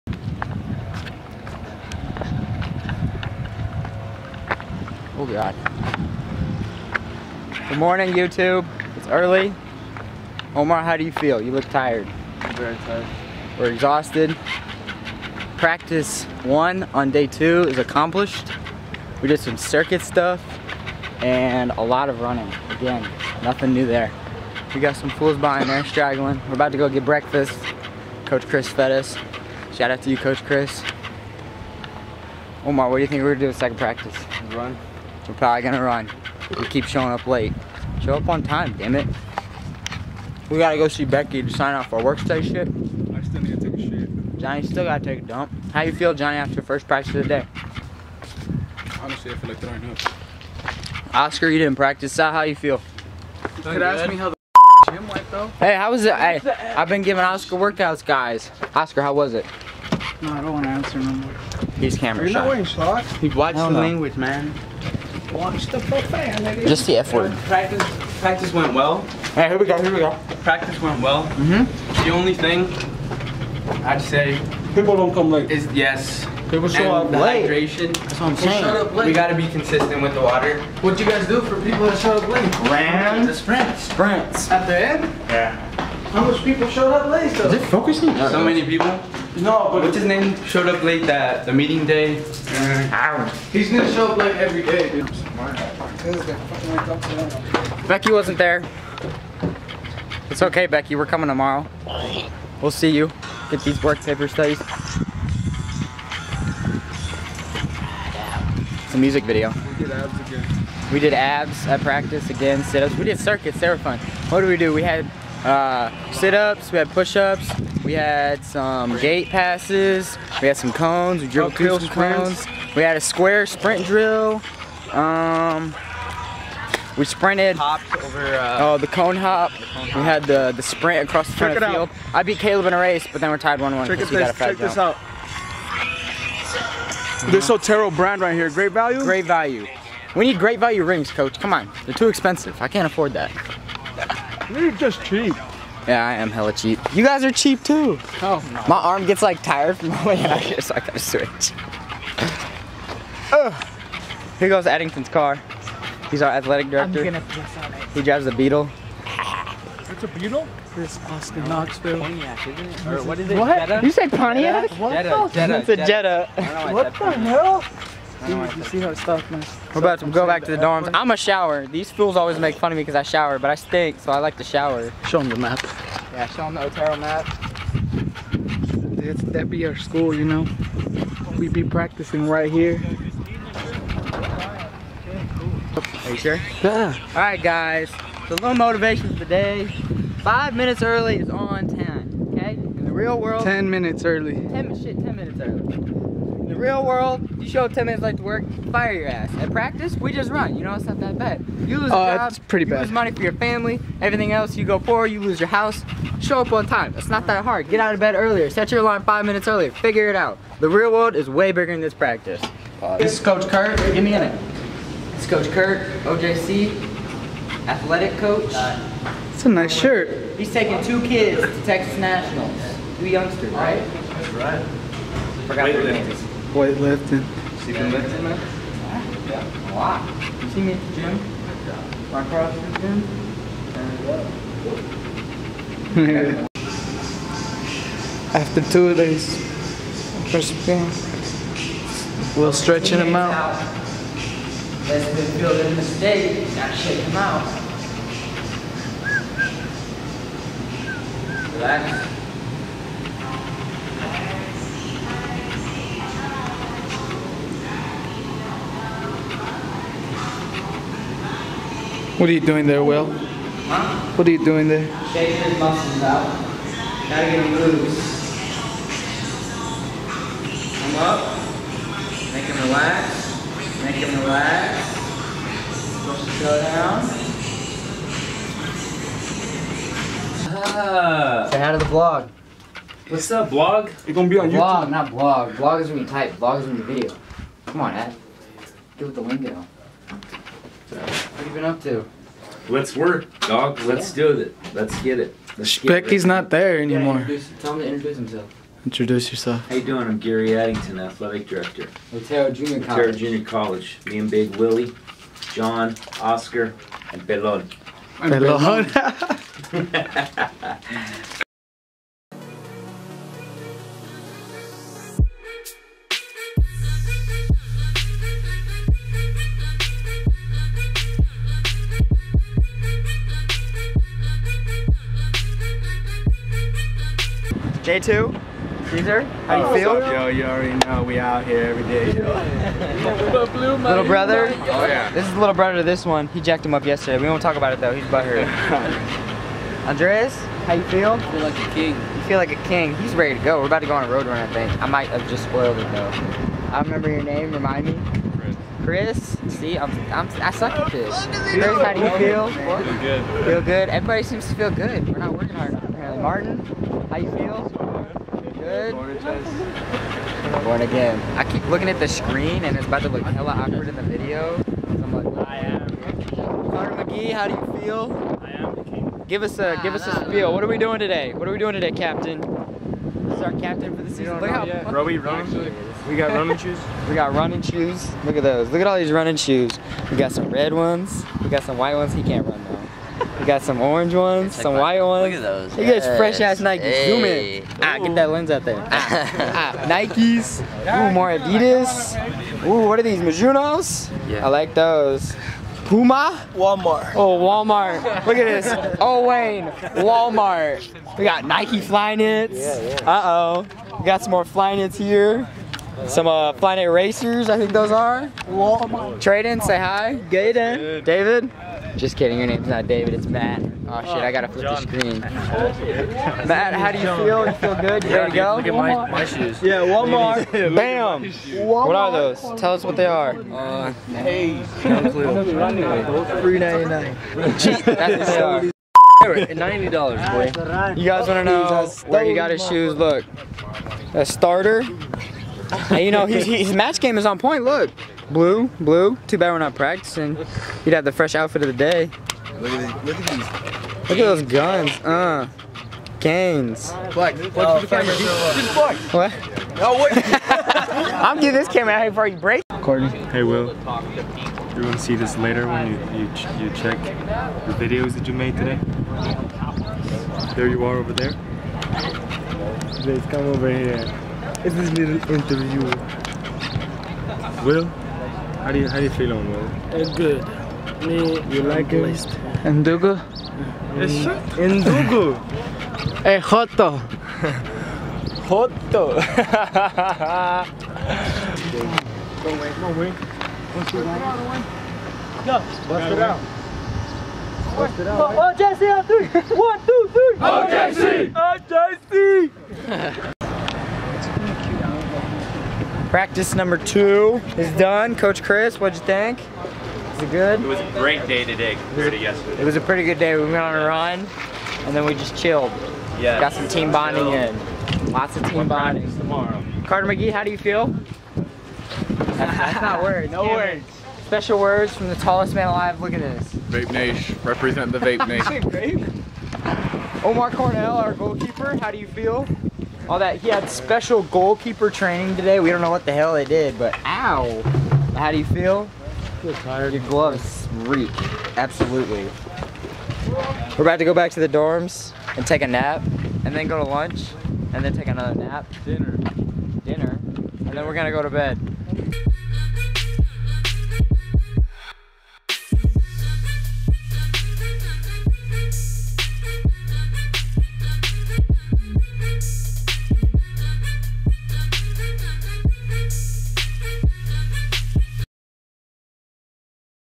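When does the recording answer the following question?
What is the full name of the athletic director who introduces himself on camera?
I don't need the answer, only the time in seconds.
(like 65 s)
300 s.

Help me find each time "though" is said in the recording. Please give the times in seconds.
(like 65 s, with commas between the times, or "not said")
55 s, 87 s, 337 s, 345 s, 382 s.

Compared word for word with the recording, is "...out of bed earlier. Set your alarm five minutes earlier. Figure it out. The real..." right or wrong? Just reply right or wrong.
right.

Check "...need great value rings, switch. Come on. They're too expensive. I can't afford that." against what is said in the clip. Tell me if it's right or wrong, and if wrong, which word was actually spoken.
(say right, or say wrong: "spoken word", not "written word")
wrong: "coach", not "switch".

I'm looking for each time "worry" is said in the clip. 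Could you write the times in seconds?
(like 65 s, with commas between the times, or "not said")
not said.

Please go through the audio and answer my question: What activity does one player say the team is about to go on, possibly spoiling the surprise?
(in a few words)
a road run.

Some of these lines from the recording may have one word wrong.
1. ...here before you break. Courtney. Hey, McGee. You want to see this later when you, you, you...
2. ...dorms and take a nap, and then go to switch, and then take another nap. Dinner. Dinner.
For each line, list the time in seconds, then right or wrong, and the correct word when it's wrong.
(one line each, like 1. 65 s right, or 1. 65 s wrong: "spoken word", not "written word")
1. 452 s wrong: "Will", not "McGee"
2. 534 s wrong: "lunch", not "switch".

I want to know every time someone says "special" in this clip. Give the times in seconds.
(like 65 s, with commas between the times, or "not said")
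514 s, 523 s.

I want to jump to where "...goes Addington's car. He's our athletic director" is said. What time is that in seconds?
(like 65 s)
154 s.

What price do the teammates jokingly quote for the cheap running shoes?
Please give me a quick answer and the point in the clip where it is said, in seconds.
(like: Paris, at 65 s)
$3.99, at 426 s.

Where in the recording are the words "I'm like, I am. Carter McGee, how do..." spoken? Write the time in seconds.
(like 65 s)
364 s.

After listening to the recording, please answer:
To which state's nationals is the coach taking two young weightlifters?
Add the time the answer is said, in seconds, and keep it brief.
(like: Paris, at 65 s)
Texas, at 221 s.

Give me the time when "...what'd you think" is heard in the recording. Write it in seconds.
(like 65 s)
498 s.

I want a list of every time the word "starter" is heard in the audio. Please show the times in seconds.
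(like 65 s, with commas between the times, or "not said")
434 s.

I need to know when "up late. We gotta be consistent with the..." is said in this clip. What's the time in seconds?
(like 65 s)
78 s.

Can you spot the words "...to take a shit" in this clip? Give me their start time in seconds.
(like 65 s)
43 s.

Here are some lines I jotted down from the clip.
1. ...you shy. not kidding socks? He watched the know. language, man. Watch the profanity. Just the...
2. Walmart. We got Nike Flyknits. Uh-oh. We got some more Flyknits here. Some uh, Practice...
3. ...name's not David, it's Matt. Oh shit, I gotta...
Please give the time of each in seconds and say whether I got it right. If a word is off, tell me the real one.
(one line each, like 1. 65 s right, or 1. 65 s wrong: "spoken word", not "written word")
1. 62 s wrong: "wearing", not "kidding"
2. 400 s wrong: "Flyknit", not "Practice"
3. 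412 s right.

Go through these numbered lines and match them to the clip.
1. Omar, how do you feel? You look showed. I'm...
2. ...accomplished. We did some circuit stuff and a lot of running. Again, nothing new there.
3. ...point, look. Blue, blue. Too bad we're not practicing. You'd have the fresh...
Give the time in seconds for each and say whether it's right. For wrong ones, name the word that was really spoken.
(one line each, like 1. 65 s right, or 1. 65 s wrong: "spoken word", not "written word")
1. 10 s wrong: "tired", not "showed"
2. 17 s right
3. 437 s right.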